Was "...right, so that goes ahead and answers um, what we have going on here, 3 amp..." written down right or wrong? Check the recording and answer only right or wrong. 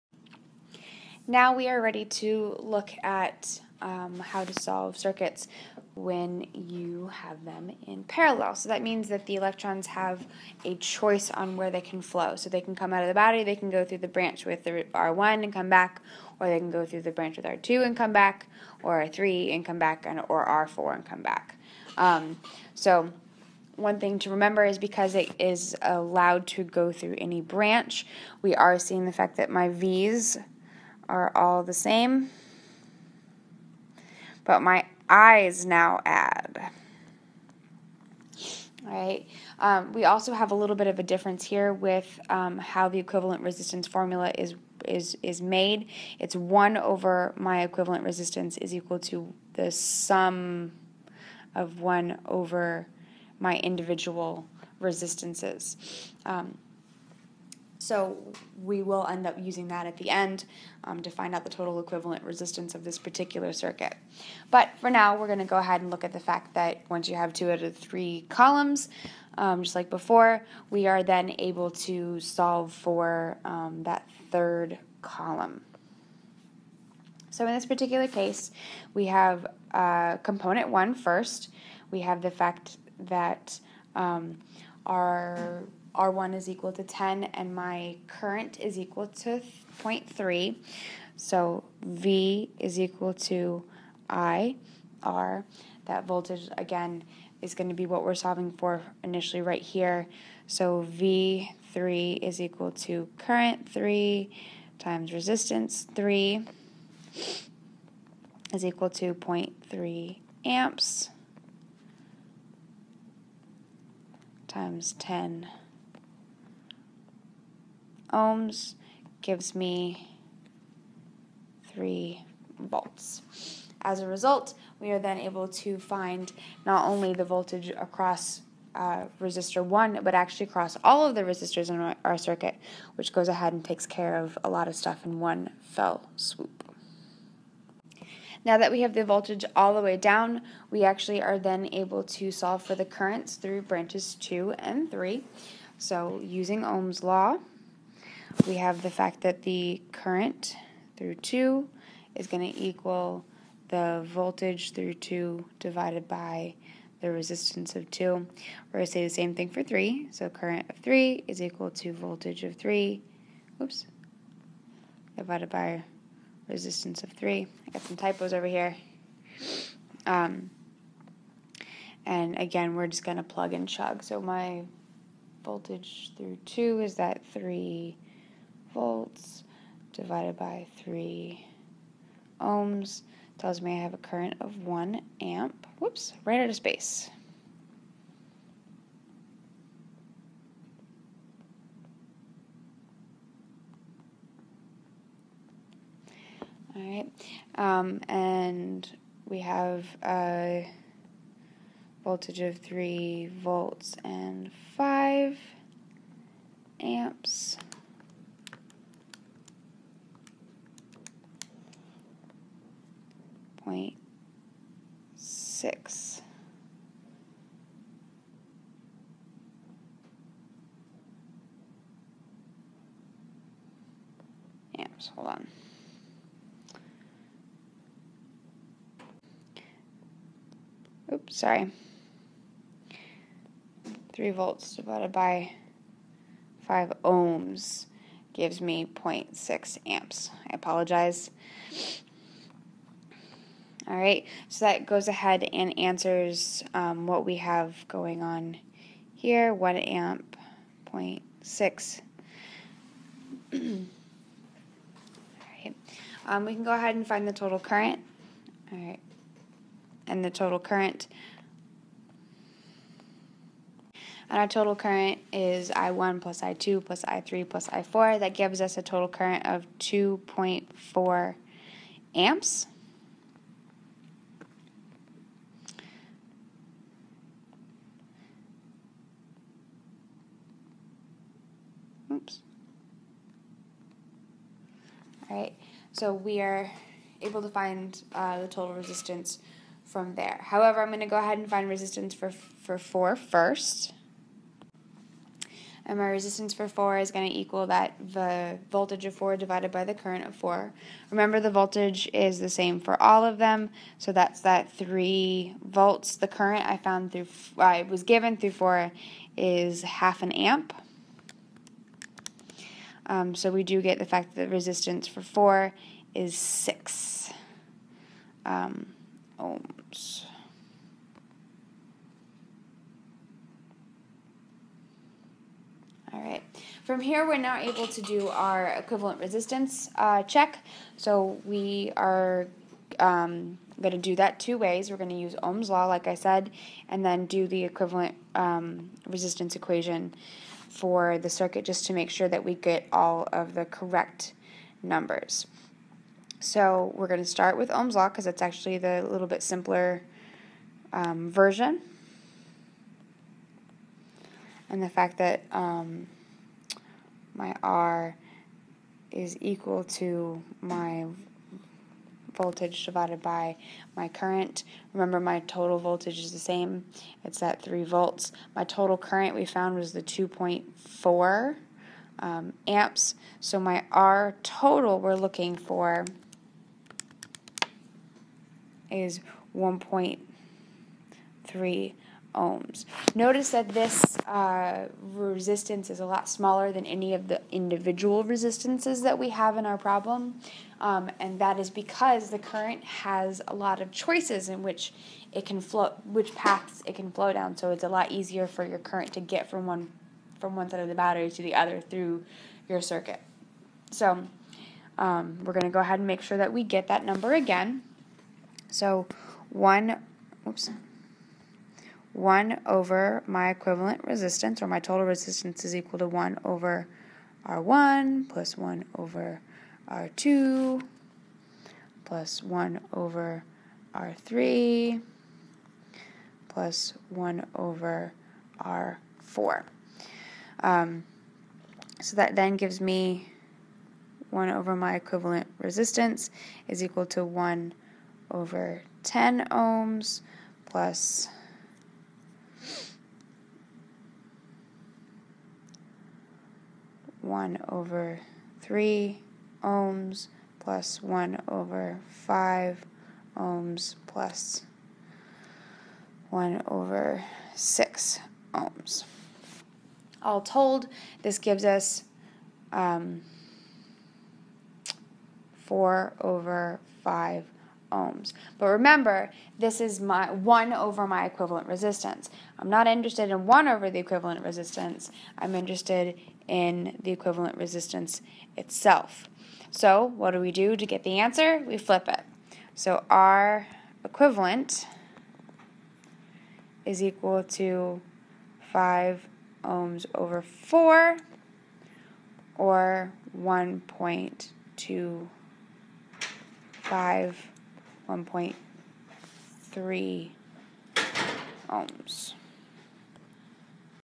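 wrong.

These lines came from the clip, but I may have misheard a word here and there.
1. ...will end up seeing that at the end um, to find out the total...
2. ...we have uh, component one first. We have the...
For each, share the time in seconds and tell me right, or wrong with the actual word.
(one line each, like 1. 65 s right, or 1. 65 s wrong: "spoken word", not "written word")
1. 58 s wrong: "using", not "seeing"
2. 78 s right.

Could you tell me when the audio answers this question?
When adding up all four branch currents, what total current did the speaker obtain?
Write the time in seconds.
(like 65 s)
269 s.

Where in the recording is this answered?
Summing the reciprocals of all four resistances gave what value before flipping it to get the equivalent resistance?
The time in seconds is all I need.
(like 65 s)
465 s.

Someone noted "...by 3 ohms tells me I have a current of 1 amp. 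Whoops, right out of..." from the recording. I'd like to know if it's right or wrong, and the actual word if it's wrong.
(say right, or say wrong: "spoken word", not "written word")
right.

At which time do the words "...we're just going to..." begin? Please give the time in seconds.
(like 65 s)
172 s.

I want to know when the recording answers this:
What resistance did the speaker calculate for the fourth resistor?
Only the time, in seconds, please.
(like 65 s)
316 s.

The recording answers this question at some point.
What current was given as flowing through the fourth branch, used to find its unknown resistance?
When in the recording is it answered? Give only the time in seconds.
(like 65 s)
309 s.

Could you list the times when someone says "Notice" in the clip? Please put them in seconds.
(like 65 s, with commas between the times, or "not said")
383 s.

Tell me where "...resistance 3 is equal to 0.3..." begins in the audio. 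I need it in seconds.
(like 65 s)
105 s.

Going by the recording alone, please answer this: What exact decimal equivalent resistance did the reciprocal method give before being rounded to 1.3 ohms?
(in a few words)
1.25.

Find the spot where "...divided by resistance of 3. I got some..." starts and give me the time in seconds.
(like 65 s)
165 s.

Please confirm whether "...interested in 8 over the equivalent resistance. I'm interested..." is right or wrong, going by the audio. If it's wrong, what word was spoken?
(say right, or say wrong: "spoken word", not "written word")
wrong: "1", not "8".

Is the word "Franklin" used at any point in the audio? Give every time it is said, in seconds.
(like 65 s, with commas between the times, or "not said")
not said.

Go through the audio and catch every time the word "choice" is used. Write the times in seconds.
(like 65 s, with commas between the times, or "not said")
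10 s, 393 s.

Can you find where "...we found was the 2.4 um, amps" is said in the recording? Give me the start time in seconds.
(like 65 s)
369 s.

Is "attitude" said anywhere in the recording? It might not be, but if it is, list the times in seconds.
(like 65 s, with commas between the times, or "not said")
not said.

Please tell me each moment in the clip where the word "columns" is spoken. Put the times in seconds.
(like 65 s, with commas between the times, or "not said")
68 s, 75 s.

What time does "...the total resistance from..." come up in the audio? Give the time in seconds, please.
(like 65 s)
288 s.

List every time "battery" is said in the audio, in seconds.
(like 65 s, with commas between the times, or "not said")
13 s, 400 s.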